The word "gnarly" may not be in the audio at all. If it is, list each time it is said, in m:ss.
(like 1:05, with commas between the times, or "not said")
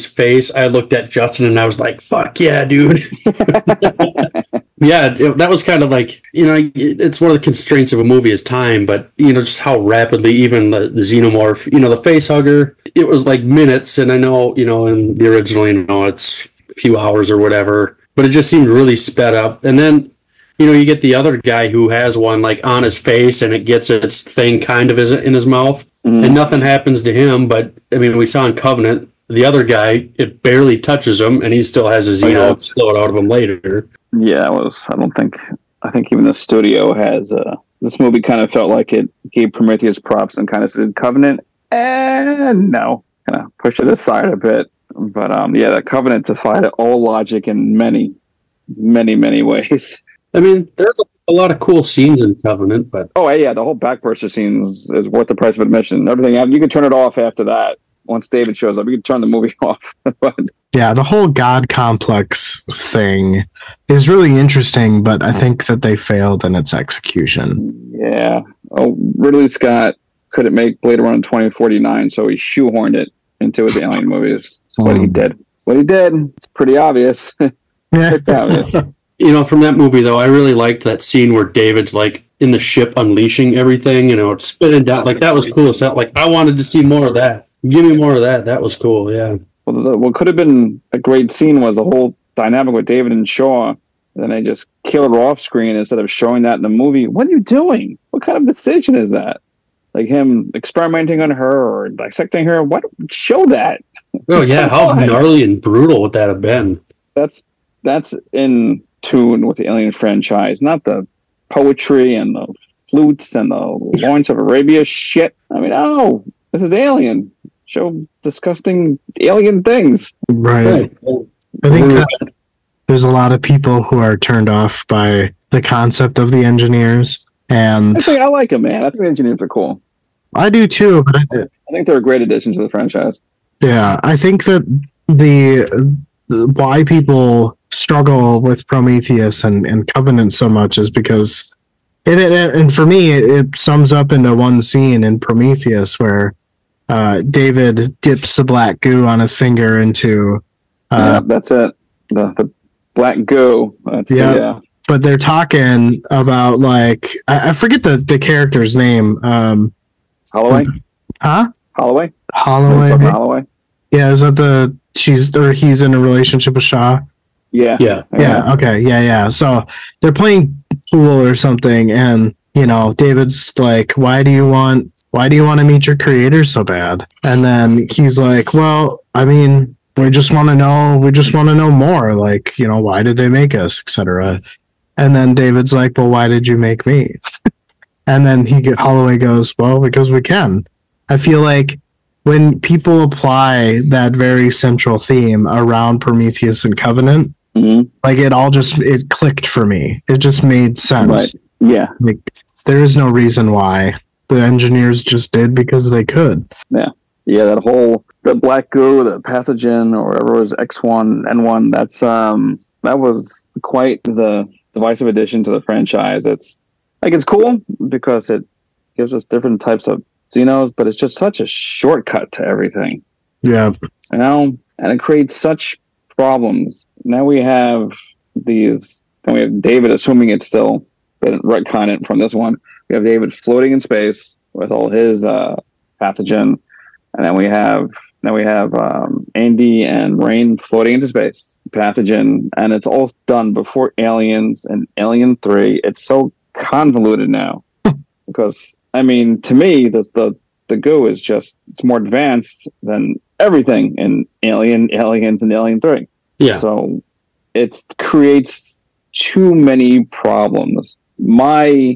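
1:45.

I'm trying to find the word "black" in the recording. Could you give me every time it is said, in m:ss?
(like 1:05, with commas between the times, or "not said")
2:28, 2:32, 3:28.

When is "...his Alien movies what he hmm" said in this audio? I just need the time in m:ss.
1:13.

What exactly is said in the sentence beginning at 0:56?
Everything you can turn it off after that.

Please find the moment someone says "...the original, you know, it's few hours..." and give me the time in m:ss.
0:15.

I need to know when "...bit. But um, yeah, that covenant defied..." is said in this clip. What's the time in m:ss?
0:44.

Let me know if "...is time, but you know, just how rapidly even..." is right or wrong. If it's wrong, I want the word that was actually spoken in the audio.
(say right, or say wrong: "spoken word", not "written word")
right.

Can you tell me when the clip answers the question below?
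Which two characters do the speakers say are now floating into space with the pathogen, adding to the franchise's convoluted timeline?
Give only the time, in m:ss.
3:59.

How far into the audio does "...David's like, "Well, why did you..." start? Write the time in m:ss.
3:05.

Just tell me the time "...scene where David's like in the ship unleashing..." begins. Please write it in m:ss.
1:21.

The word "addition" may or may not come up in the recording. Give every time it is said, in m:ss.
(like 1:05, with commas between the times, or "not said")
2:12, 3:35.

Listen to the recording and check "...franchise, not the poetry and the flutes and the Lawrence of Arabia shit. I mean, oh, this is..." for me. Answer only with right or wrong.
right.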